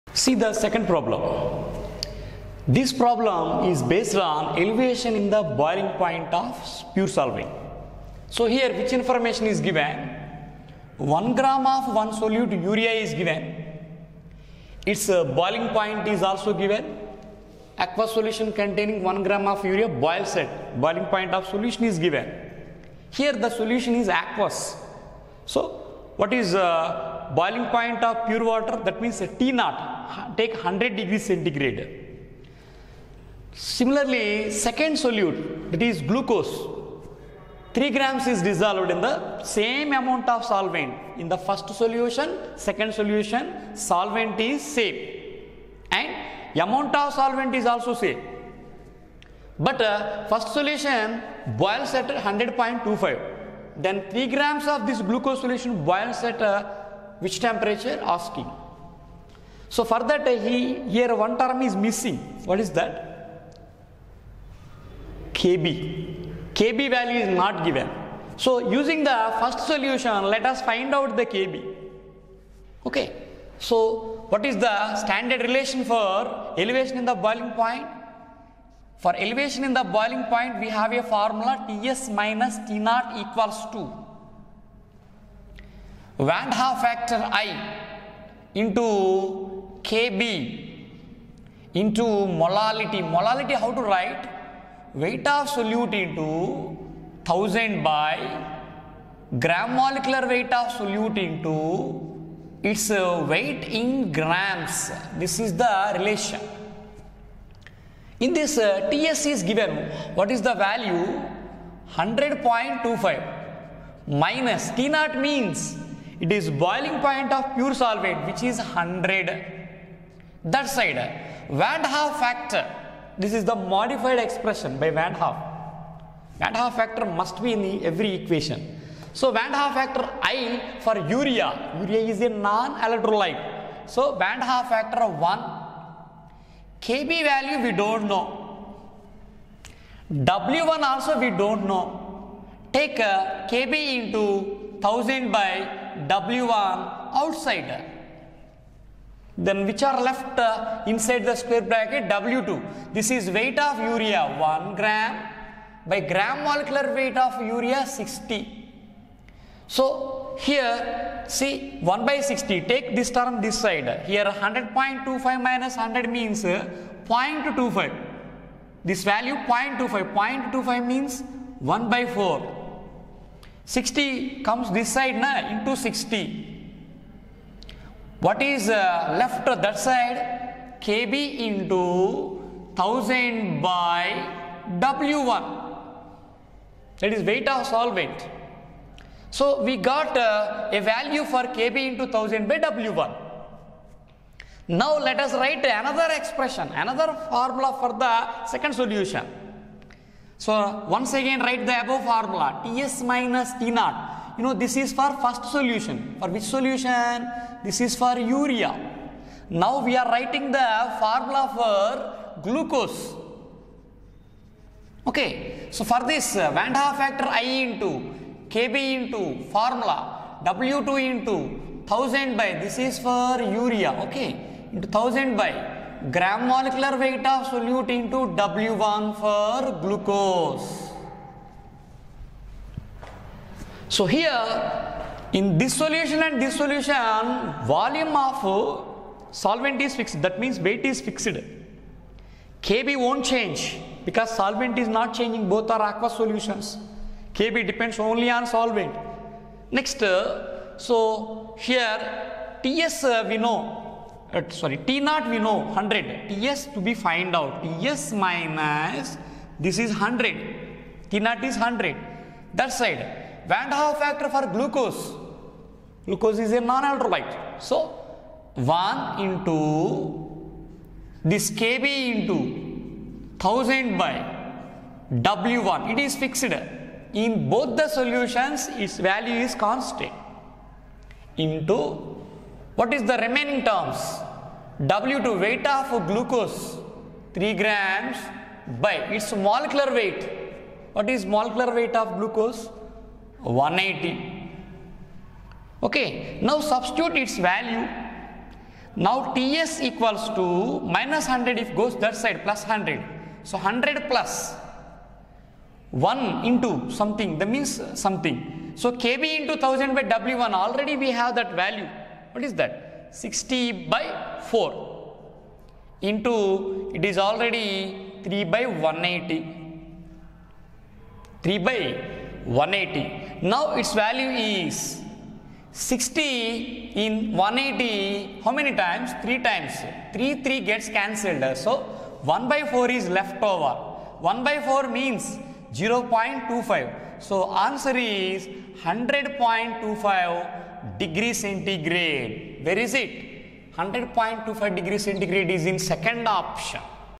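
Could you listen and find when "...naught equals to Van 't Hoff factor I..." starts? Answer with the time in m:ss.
1:22.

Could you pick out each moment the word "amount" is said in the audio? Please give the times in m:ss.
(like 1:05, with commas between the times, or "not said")
0:39, 0:46.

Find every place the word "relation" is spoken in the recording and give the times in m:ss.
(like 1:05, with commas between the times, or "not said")
1:15, 1:45.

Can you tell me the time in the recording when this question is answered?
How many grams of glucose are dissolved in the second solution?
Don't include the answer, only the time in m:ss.
4:45.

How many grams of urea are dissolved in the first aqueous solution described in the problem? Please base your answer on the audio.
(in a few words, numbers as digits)
1 gram.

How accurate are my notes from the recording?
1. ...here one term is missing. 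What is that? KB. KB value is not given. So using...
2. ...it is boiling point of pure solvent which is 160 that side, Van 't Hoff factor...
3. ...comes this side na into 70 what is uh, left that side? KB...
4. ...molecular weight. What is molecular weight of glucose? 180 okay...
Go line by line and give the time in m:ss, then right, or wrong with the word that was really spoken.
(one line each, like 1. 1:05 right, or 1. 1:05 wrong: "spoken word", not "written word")
1. 1:00 right
2. 1:56 wrong: "100", not "160"
3. 2:54 wrong: "60", not "70"
4. 4:49 right.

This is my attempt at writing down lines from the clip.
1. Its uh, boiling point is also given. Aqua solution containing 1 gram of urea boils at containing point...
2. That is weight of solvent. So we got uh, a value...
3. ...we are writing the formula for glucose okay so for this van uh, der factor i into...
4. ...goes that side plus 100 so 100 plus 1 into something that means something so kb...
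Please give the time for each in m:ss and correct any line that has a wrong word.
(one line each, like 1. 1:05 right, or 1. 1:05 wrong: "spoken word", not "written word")
1. 0:14 wrong: "boiling", not "containing"
2. 3:07 right
3. 3:29 right
4. 5:01 right.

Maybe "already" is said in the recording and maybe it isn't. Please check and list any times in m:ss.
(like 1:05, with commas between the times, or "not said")
5:10, 5:17.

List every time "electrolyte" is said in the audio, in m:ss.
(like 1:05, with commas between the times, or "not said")
2:12, 4:26.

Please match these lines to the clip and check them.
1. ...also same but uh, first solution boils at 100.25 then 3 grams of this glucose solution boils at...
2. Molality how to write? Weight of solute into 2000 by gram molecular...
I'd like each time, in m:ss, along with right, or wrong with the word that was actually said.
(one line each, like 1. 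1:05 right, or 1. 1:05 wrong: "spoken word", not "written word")
1. 0:47 right
2. 1:33 wrong: "1000", not "2000".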